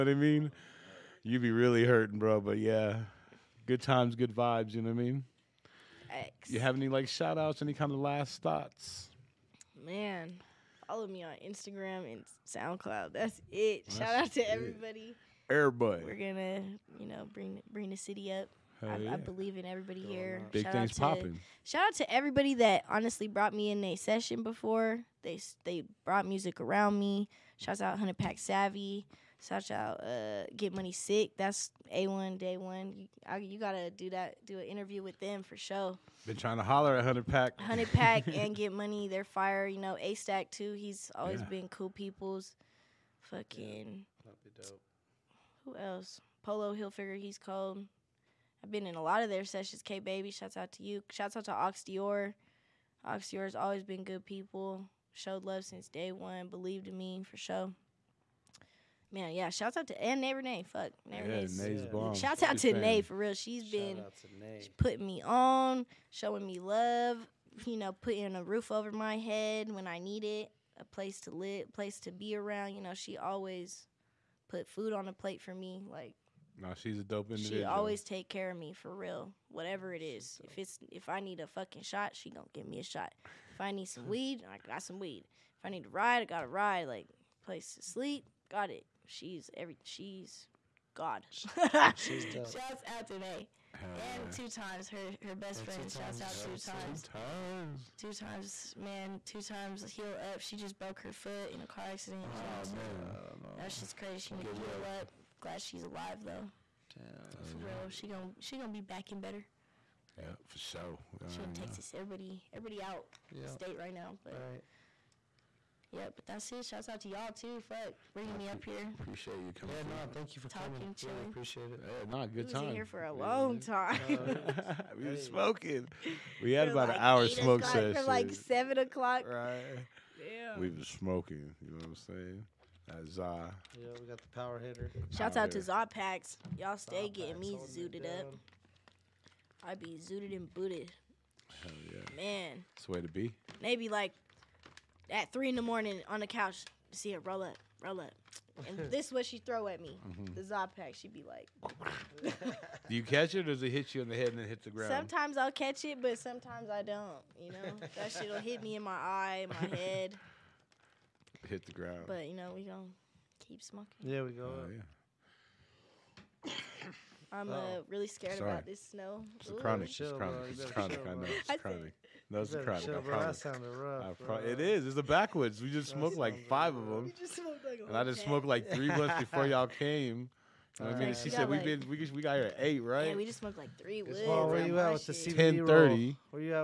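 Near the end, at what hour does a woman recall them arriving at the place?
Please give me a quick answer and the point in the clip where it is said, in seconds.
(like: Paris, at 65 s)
8, at 182 s.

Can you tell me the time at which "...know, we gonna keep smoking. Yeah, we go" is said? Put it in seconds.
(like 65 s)
162 s.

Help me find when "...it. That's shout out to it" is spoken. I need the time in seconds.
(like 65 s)
13 s.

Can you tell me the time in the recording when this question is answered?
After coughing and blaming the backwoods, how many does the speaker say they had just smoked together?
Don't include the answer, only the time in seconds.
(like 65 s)
176 s.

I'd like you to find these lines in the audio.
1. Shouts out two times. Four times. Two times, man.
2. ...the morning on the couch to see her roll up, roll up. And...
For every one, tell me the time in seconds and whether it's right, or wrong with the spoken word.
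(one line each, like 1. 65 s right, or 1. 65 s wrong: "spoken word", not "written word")
1. 95 s wrong: "Two", not "Four"
2. 145 s right.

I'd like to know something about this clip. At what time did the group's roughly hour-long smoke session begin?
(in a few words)
7 o'clock.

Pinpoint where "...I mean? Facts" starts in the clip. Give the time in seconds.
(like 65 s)
4 s.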